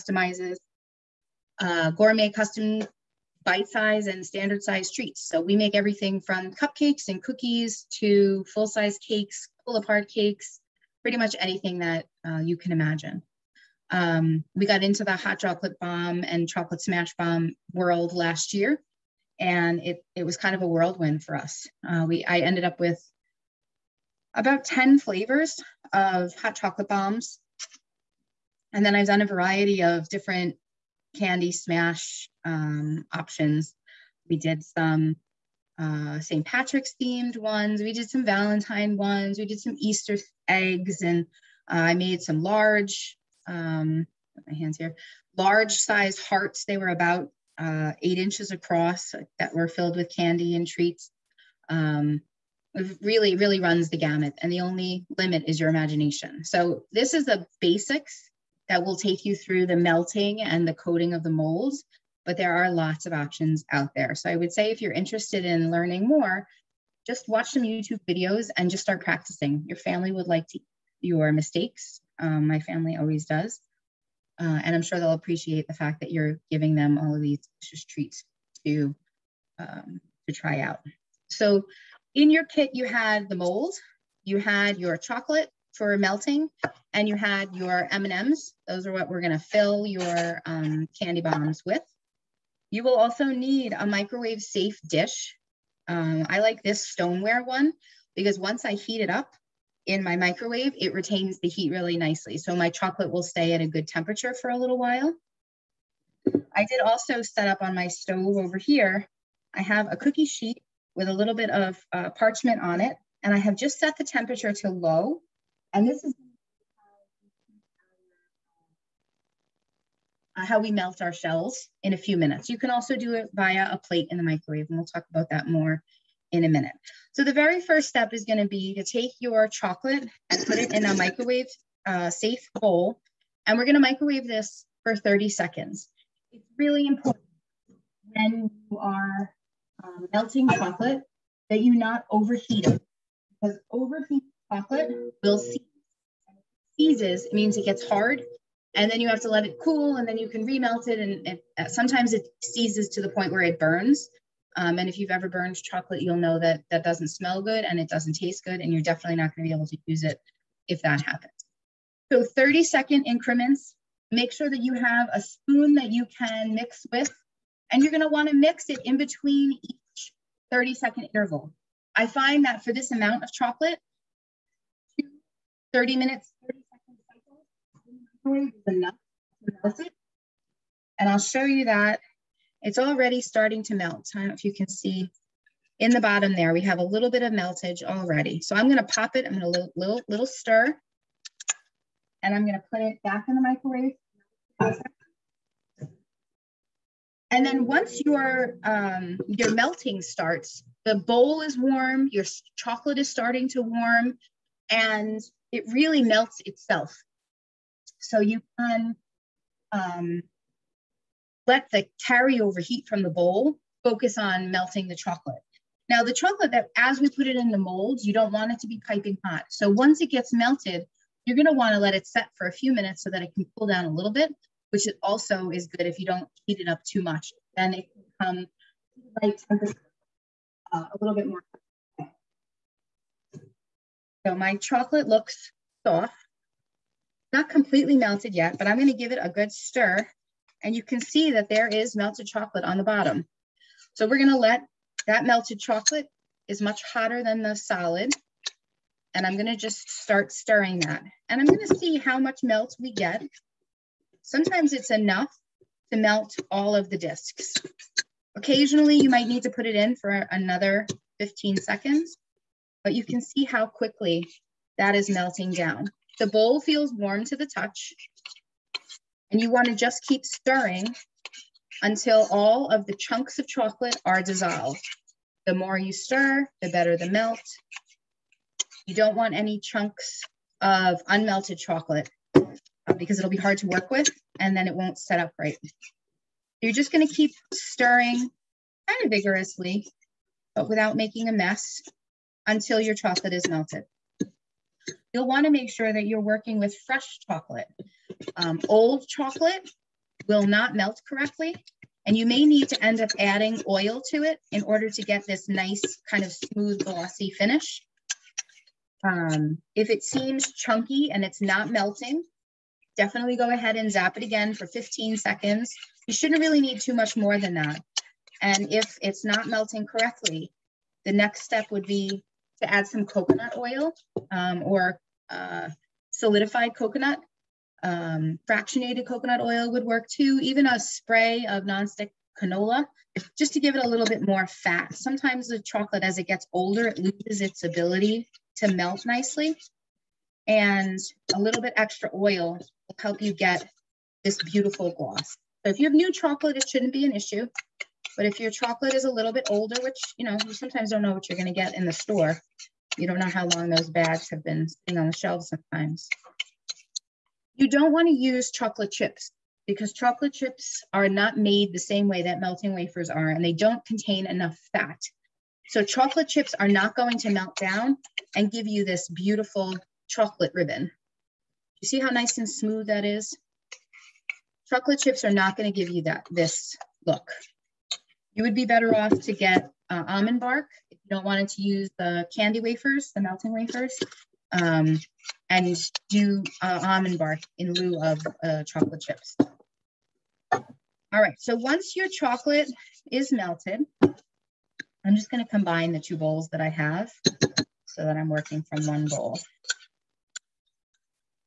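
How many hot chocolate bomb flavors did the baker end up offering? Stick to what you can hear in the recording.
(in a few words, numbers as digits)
10.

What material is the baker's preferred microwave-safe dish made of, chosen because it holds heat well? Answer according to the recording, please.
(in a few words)
Stoneware.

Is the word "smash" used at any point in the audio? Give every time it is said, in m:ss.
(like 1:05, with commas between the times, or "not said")
0:16, 0:31.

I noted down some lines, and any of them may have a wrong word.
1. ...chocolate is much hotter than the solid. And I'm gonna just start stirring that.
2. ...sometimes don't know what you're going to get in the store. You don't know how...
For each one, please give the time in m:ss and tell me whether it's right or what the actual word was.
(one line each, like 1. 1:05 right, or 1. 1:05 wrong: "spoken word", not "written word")
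1. 4:05 right
2. 5:50 right.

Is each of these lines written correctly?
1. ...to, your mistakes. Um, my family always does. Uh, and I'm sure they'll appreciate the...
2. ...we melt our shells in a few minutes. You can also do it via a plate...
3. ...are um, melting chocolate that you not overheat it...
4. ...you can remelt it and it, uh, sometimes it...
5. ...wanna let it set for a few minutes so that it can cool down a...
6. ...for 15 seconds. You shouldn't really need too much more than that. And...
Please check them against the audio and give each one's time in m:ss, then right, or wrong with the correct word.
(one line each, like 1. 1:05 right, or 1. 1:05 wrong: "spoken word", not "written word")
1. 1:10 right
2. 2:00 right
3. 2:18 right
4. 2:30 right
5. 3:41 right
6. 5:14 right.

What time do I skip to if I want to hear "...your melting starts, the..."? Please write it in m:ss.
3:19.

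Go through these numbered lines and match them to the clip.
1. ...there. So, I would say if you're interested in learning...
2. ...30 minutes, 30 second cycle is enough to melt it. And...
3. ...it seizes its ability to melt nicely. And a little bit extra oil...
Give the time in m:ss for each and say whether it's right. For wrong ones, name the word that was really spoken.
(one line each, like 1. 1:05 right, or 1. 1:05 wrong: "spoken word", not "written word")
1. 1:03 right
2. 2:55 right
3. 5:36 wrong: "loses", not "seizes".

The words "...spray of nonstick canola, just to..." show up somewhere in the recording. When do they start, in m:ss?
5:30.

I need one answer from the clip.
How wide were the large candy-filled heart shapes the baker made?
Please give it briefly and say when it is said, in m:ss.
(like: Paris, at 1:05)
8 inches, at 0:48.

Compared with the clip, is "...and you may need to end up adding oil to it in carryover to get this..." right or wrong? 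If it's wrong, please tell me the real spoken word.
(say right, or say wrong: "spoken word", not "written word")
wrong: "order", not "carryover".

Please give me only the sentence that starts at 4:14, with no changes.
Sometimes it's enough to melt all of the discs.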